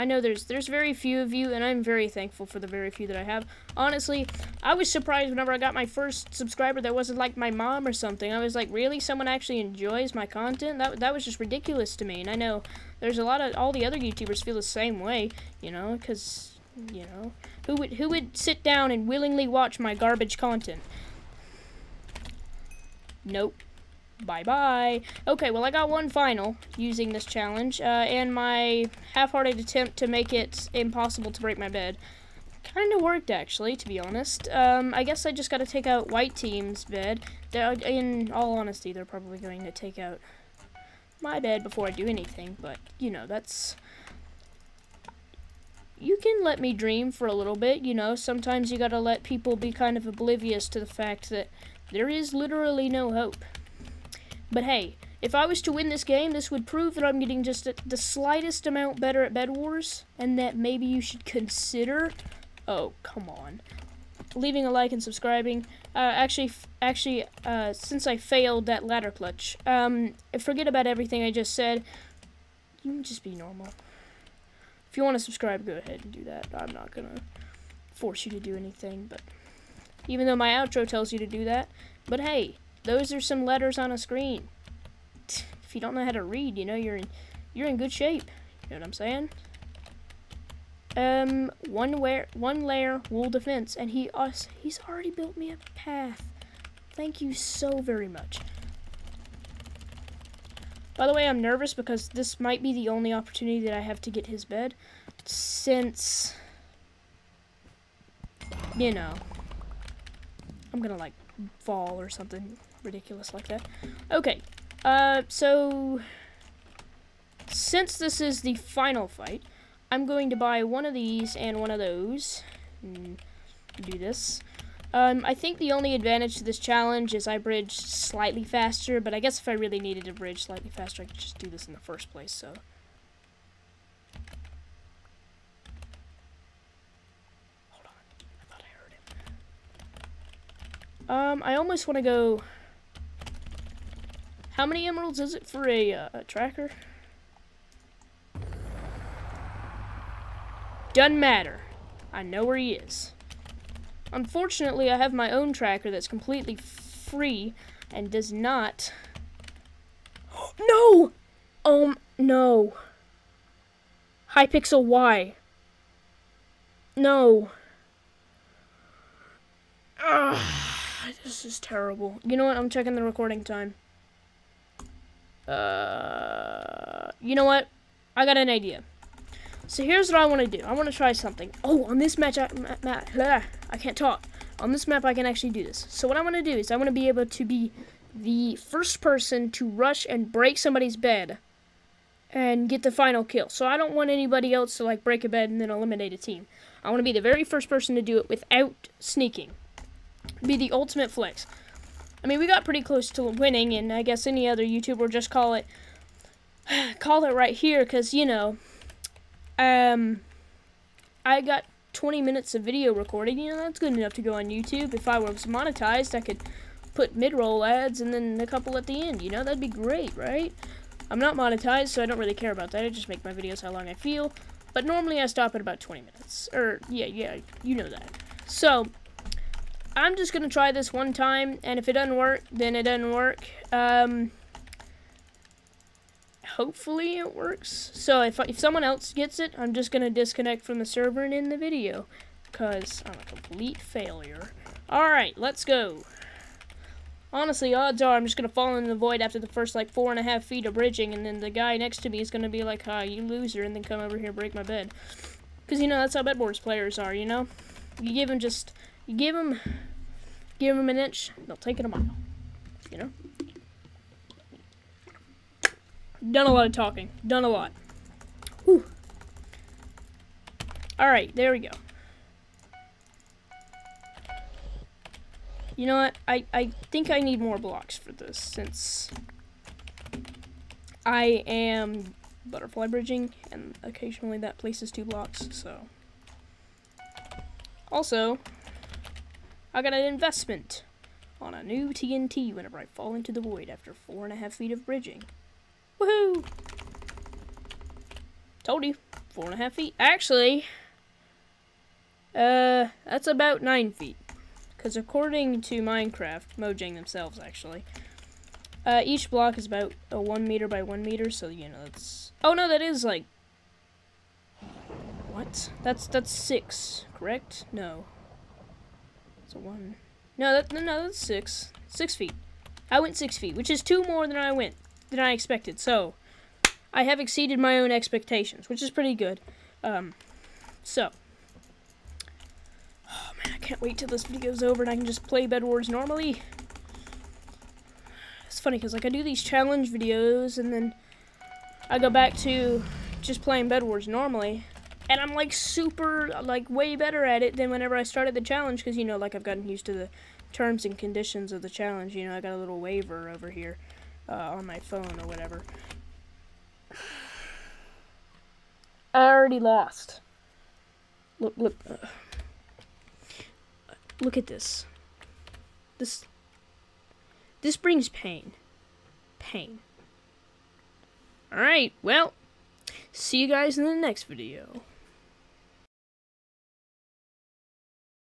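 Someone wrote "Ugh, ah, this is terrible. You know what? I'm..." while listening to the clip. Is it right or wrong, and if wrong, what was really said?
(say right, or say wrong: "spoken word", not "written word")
right.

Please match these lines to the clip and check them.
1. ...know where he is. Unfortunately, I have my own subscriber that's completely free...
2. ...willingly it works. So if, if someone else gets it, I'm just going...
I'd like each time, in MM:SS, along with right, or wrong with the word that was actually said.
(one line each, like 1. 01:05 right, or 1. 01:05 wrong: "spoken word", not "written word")
1. 02:32 wrong: "tracker", not "subscriber"
2. 03:56 wrong: "hopefully", not "willingly".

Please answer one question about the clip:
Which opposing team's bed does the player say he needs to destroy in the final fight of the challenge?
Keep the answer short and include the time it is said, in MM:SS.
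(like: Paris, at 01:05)
White Team, at 00:36.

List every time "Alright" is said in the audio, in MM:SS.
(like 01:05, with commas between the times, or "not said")
04:04, 04:30, 06:11.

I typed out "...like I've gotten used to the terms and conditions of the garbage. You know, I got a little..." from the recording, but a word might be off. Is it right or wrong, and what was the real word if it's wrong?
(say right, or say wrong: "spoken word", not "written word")
wrong: "challenge", not "garbage".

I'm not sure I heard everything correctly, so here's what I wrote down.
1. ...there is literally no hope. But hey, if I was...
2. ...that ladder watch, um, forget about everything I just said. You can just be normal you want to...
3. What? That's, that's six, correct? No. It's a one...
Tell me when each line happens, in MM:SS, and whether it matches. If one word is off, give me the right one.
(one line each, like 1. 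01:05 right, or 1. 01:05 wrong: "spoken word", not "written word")
1. 00:51 right
2. 01:08 wrong: "clutch", not "watch"
3. 05:15 right.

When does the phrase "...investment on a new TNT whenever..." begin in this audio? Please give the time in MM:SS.
04:50.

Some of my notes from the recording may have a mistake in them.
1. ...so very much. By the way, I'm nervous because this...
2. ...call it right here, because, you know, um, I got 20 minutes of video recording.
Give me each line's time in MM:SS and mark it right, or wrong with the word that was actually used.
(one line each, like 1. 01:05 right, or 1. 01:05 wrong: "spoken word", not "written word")
1. 01:37 right
2. 03:26 right.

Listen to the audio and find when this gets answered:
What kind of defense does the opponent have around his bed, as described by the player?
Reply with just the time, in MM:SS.
01:32.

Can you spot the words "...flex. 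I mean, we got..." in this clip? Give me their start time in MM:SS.
03:21.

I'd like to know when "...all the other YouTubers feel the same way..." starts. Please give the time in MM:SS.
00:13.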